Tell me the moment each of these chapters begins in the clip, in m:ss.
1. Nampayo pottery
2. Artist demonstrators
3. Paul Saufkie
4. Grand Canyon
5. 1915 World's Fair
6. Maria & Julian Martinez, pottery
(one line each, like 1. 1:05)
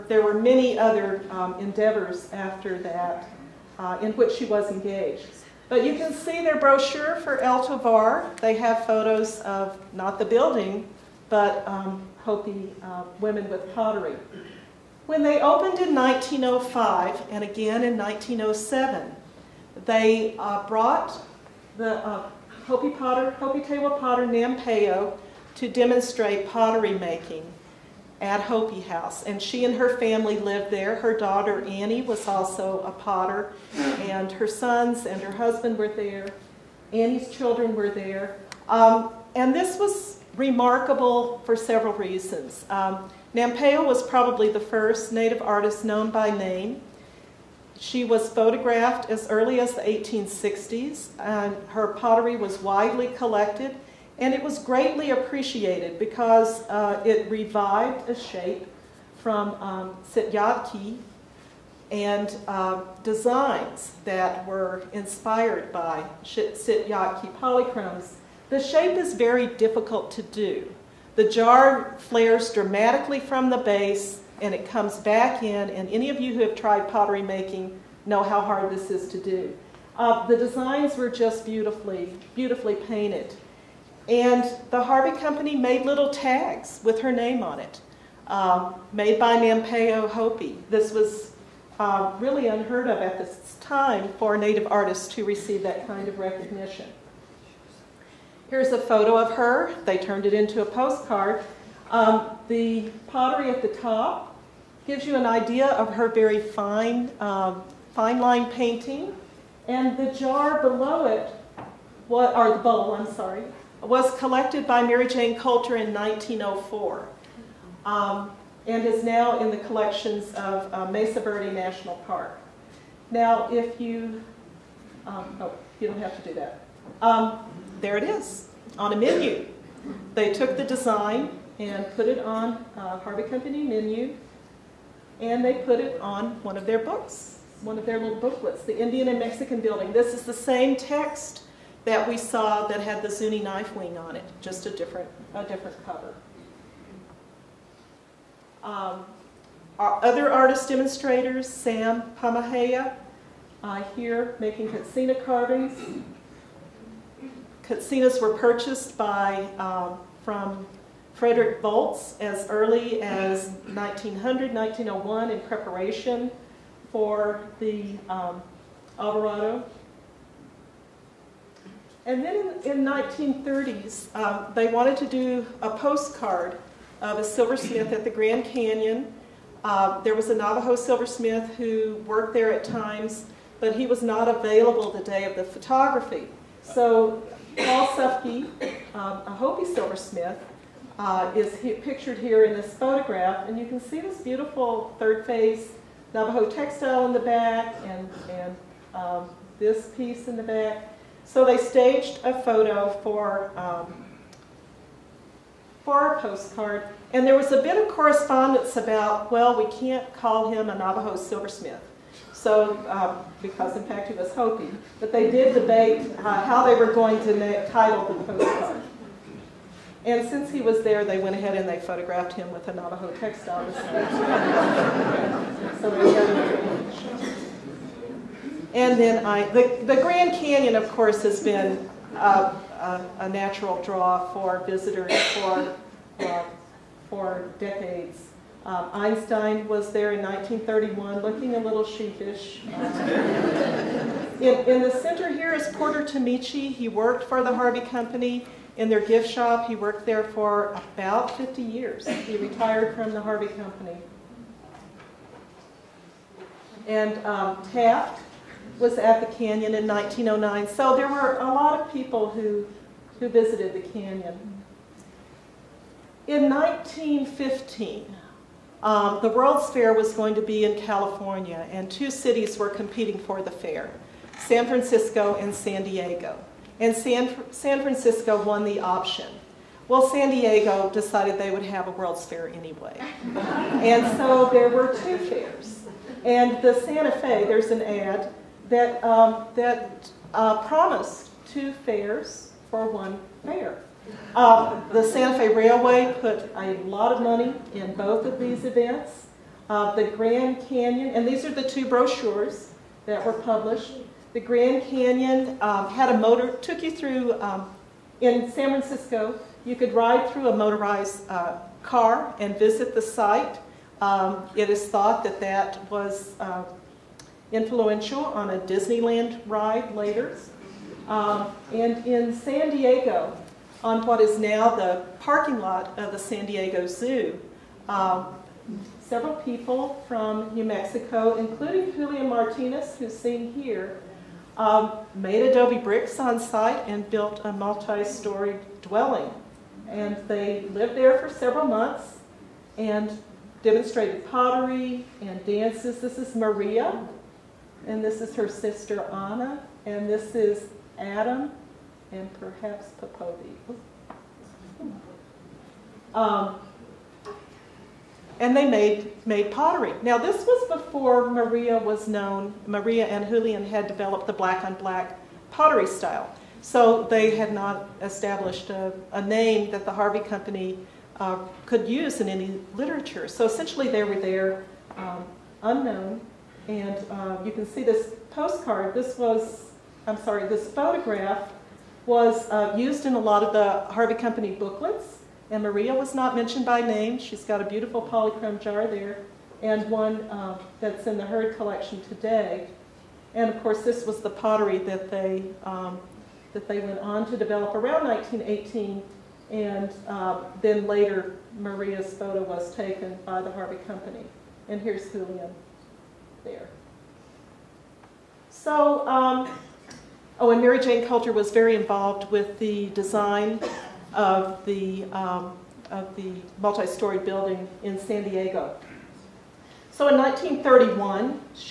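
1. 0:27
2. 2:28
3. 3:02
4. 3:47
5. 4:32
6. 6:02.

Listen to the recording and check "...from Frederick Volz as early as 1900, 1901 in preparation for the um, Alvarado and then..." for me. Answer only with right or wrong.
right.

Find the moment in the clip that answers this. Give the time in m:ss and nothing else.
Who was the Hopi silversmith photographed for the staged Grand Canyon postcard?
3:07.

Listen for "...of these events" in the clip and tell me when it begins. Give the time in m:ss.
4:58.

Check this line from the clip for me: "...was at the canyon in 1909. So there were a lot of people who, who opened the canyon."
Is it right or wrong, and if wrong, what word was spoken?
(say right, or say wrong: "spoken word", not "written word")
wrong: "visited", not "opened".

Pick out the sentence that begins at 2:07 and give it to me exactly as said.
Um, there it is, on a menu.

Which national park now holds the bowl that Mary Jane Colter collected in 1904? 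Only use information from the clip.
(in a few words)
Mesa Verde National Park.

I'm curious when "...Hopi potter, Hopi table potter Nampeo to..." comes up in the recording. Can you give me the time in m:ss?
0:22.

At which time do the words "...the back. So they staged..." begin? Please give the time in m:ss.
3:20.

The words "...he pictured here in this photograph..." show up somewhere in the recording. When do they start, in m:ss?
3:11.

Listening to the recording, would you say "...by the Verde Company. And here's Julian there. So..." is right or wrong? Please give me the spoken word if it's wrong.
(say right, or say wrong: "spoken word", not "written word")
wrong: "Harvey", not "Verde".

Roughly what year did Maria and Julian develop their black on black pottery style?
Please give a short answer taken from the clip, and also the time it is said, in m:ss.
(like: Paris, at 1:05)
1918, at 6:38.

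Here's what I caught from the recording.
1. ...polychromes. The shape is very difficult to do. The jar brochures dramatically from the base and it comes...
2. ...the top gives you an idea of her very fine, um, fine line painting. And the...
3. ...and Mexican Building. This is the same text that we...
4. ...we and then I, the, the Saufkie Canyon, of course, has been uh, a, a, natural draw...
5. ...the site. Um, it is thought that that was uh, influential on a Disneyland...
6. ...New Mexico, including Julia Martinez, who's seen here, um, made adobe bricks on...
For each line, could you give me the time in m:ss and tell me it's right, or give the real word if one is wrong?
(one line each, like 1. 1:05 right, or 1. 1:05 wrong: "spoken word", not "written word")
1. 1:07 wrong: "flares", not "brochures"
2. 1:43 right
3. 2:19 right
4. 3:45 wrong: "Grand", not "Saufkie"
5. 5:12 right
6. 5:30 right.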